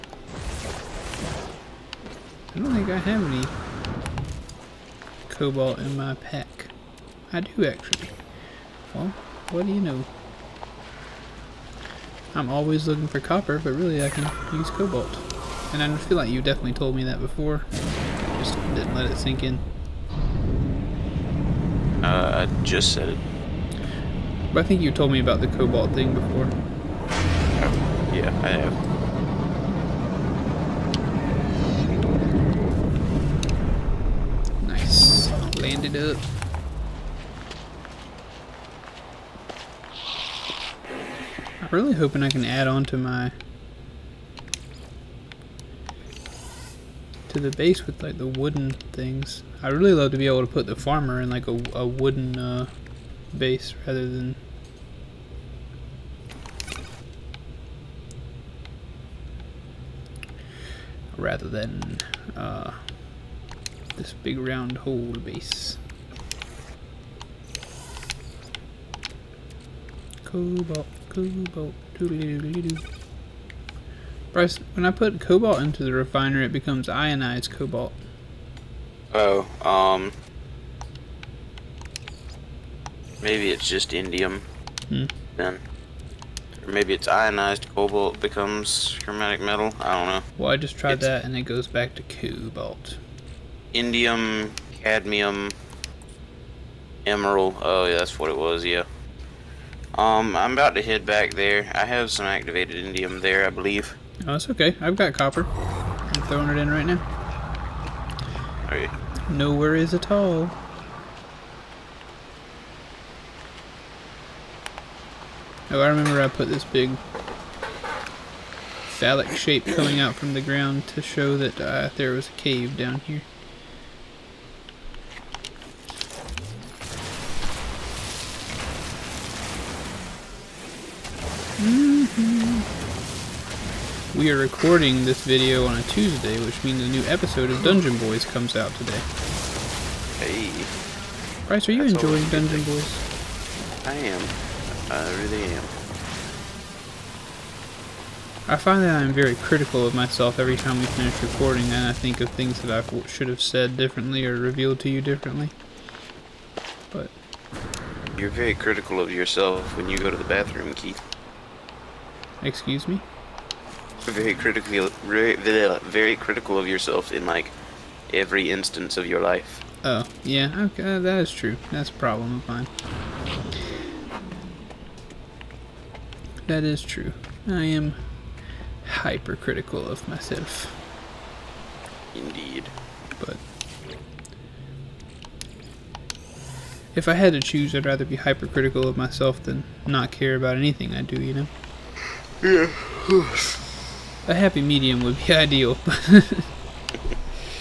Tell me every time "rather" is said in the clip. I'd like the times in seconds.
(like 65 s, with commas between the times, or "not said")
53 s, 61 s, 187 s.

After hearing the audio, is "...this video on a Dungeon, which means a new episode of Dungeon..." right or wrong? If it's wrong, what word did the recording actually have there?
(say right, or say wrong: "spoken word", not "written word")
wrong: "Tuesday", not "Dungeon".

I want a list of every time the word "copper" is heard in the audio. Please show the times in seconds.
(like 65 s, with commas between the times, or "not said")
13 s, 105 s.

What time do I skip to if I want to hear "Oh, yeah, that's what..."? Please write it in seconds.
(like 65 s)
97 s.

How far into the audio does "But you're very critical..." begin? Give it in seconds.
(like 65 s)
156 s.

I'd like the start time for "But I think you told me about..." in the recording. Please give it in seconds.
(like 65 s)
24 s.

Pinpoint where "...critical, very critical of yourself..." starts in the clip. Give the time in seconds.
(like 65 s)
164 s.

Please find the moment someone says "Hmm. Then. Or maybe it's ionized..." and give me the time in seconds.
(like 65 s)
84 s.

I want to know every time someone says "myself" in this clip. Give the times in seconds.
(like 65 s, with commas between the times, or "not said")
149 s, 180 s, 188 s.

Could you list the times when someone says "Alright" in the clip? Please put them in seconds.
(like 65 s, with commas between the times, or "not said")
108 s.